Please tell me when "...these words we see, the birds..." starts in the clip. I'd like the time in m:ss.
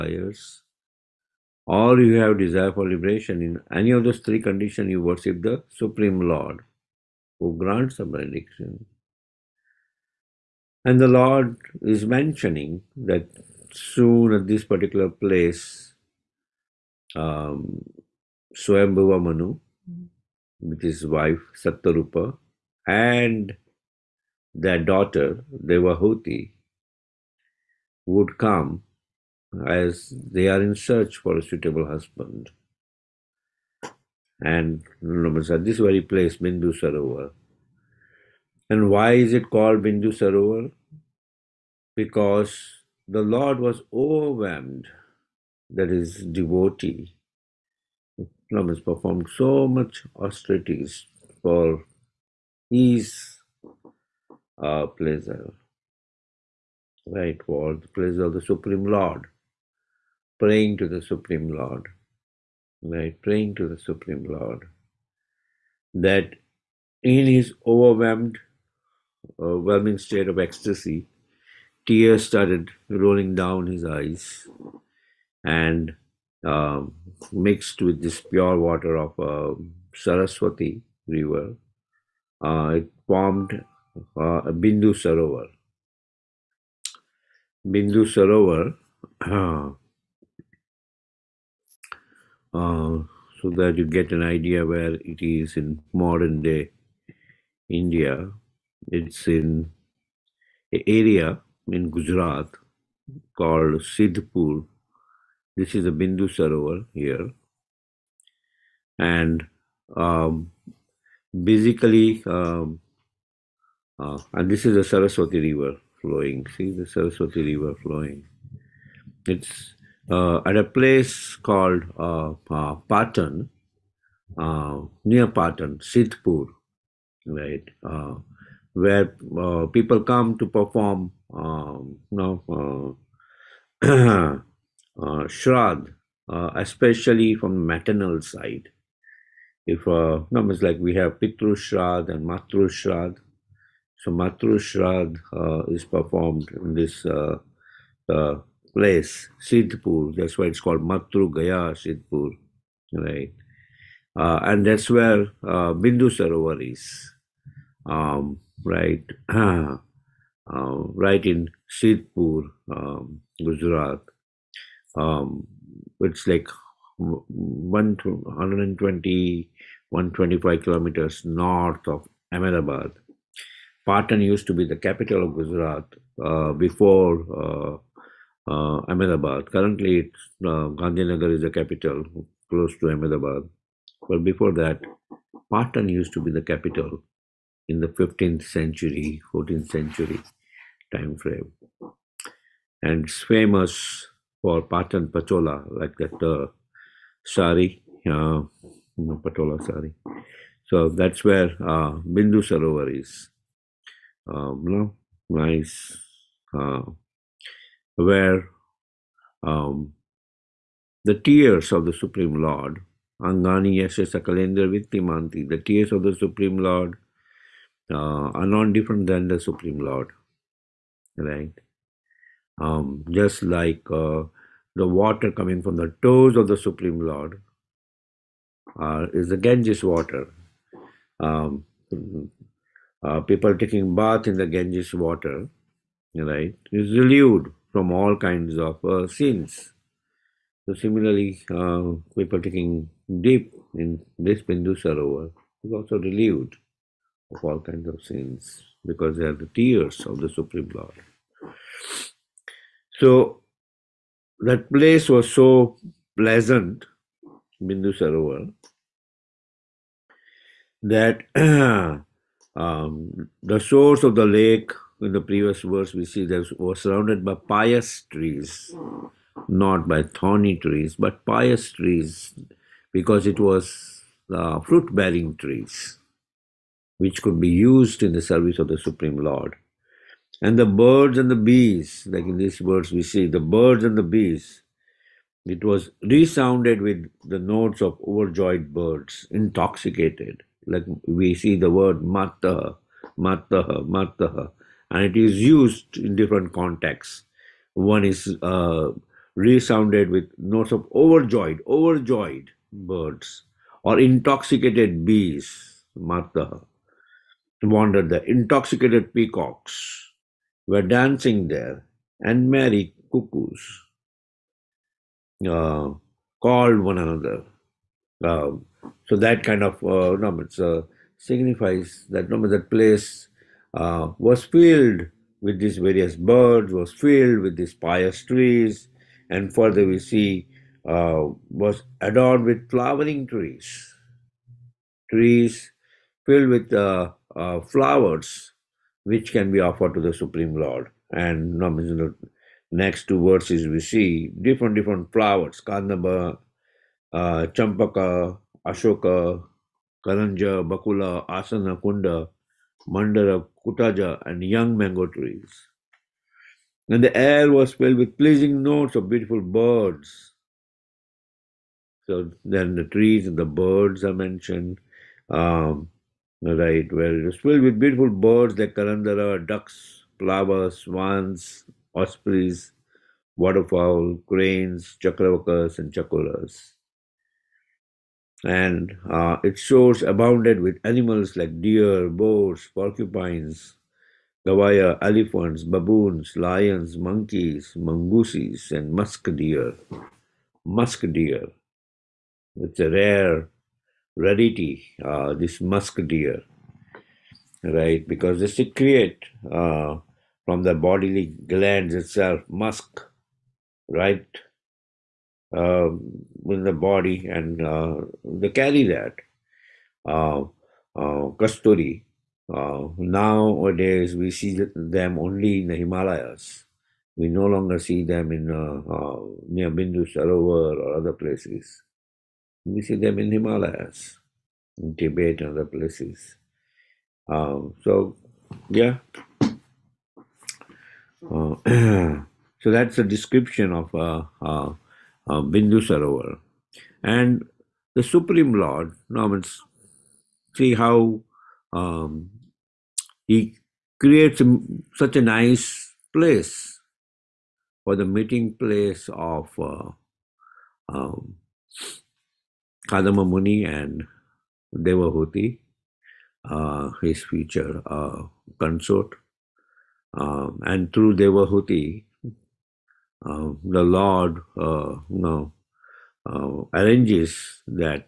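4:42.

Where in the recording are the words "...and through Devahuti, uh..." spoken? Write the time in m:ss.
7:40.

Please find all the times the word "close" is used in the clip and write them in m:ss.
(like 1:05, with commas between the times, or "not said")
3:02.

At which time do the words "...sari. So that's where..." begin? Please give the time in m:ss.
3:19.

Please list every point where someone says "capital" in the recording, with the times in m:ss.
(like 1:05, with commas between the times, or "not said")
2:54, 3:01, 3:06.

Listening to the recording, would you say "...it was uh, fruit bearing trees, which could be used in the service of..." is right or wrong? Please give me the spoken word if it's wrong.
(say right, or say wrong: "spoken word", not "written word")
right.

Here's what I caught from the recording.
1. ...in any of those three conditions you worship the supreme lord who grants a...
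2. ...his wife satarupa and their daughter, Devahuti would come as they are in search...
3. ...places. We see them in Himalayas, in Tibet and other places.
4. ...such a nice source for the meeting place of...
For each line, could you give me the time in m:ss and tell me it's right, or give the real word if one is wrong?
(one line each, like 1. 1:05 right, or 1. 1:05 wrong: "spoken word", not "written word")
1. 0:03 right
2. 0:20 right
3. 7:01 right
4. 7:24 wrong: "place", not "source".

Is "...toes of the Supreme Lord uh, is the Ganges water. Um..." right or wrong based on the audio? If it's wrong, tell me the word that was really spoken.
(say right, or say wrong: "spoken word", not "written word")
right.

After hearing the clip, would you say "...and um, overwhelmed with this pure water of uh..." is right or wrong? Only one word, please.
wrong.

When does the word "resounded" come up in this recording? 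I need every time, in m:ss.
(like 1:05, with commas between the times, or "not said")
4:46, 4:59.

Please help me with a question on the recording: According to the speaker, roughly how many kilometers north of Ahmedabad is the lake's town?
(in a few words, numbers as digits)
120-125.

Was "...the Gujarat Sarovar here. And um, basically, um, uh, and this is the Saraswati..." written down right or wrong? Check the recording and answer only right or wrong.
wrong.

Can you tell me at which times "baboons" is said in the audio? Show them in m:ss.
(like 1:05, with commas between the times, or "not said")
6:25.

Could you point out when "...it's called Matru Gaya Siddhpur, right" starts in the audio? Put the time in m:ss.
2:30.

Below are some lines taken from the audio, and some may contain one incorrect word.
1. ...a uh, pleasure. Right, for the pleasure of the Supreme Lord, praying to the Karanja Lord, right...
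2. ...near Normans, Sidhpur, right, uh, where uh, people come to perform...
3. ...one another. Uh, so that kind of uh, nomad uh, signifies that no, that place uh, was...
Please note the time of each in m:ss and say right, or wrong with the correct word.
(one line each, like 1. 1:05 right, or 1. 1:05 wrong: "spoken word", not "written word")
1. 0:54 wrong: "Supreme", not "Karanja"
2. 2:05 wrong: "Patan", not "Normans"
3. 5:16 right.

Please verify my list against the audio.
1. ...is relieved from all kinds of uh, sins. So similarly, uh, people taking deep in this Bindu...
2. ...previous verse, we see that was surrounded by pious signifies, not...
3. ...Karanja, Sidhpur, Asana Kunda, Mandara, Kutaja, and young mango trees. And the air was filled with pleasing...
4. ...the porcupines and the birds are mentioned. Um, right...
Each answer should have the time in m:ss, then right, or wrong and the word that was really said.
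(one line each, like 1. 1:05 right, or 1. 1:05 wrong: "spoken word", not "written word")
1. 3:56 right
2. 4:25 wrong: "trees", not "signifies"
3. 5:50 wrong: "Bakula", not "Sidhpur"
4. 6:02 wrong: "trees", not "porcupines".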